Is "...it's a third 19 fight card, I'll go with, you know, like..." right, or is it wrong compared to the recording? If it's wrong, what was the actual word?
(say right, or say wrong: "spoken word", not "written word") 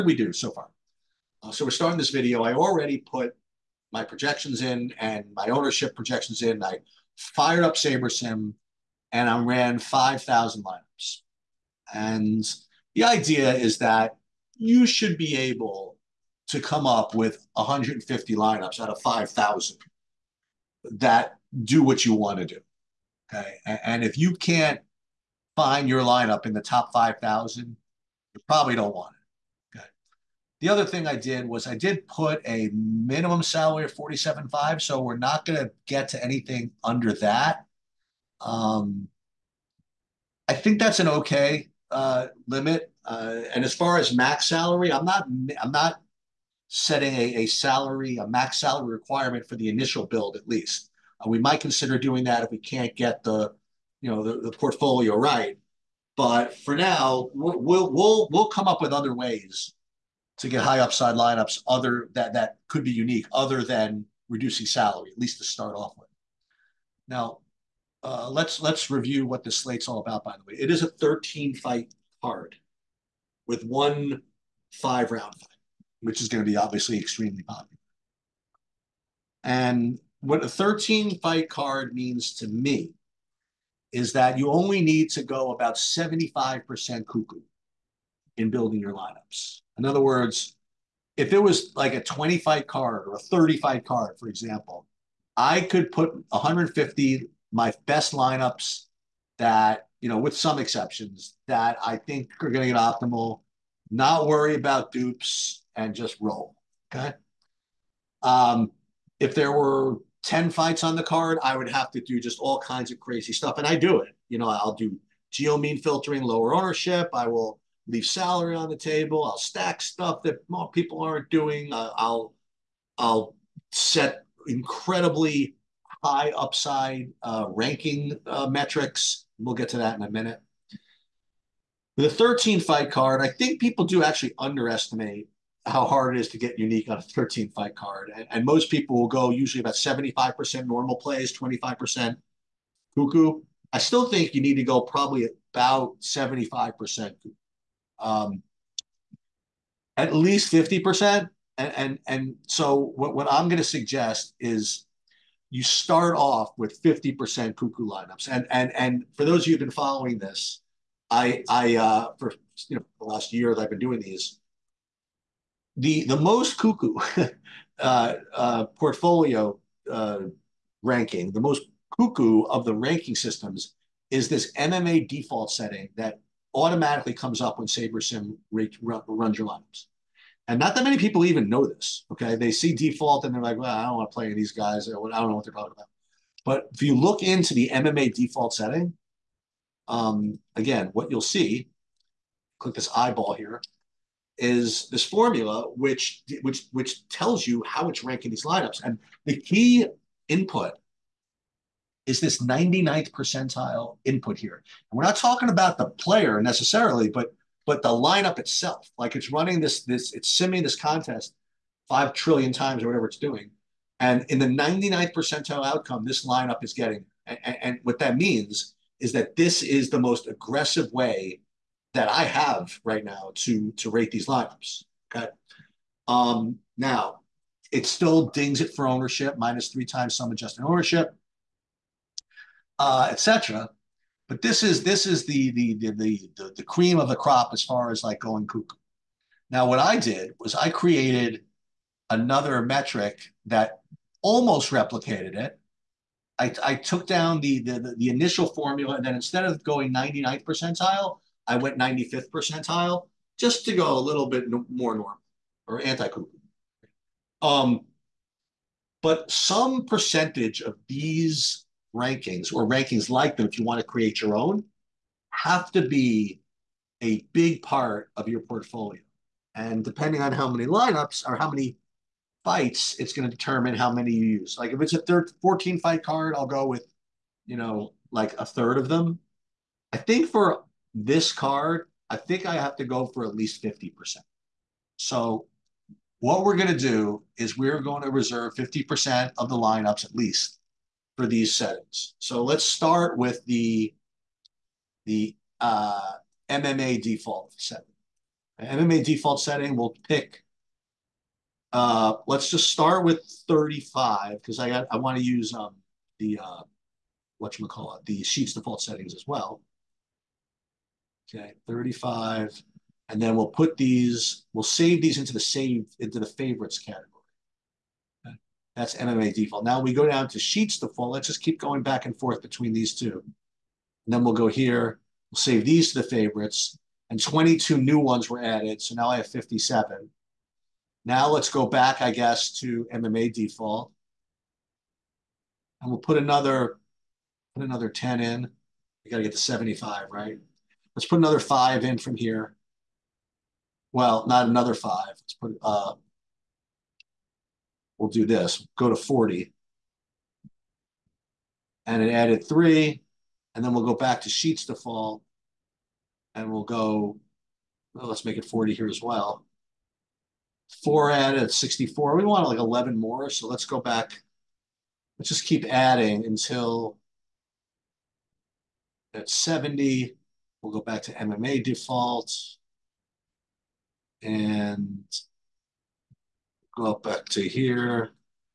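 wrong: "14", not "19".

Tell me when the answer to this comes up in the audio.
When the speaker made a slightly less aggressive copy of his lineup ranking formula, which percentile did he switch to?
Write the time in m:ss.
4:11.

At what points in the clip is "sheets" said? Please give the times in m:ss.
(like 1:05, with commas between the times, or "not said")
5:08, 5:20, 5:54.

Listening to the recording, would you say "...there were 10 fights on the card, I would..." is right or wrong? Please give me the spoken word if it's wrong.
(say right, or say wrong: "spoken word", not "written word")
right.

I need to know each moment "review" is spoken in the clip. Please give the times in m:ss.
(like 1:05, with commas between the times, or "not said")
1:08.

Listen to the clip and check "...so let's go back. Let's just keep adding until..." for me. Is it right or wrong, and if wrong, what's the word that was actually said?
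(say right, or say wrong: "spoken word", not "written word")
right.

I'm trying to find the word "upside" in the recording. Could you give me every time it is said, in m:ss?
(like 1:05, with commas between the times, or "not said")
1:00, 2:06.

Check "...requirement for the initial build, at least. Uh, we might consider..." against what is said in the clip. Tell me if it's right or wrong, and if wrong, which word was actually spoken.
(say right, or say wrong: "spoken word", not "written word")
right.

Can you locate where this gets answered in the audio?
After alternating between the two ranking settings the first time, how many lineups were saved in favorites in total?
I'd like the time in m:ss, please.
5:29.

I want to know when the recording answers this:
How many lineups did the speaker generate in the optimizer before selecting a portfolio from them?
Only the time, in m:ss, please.
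0:09.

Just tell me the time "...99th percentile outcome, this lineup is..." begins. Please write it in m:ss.
3:34.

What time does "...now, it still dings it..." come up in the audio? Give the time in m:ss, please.
3:46.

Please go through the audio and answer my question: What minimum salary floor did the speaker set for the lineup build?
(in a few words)
47.5.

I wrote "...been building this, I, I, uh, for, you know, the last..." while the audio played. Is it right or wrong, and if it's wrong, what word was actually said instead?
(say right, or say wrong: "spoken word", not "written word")
wrong: "following", not "building".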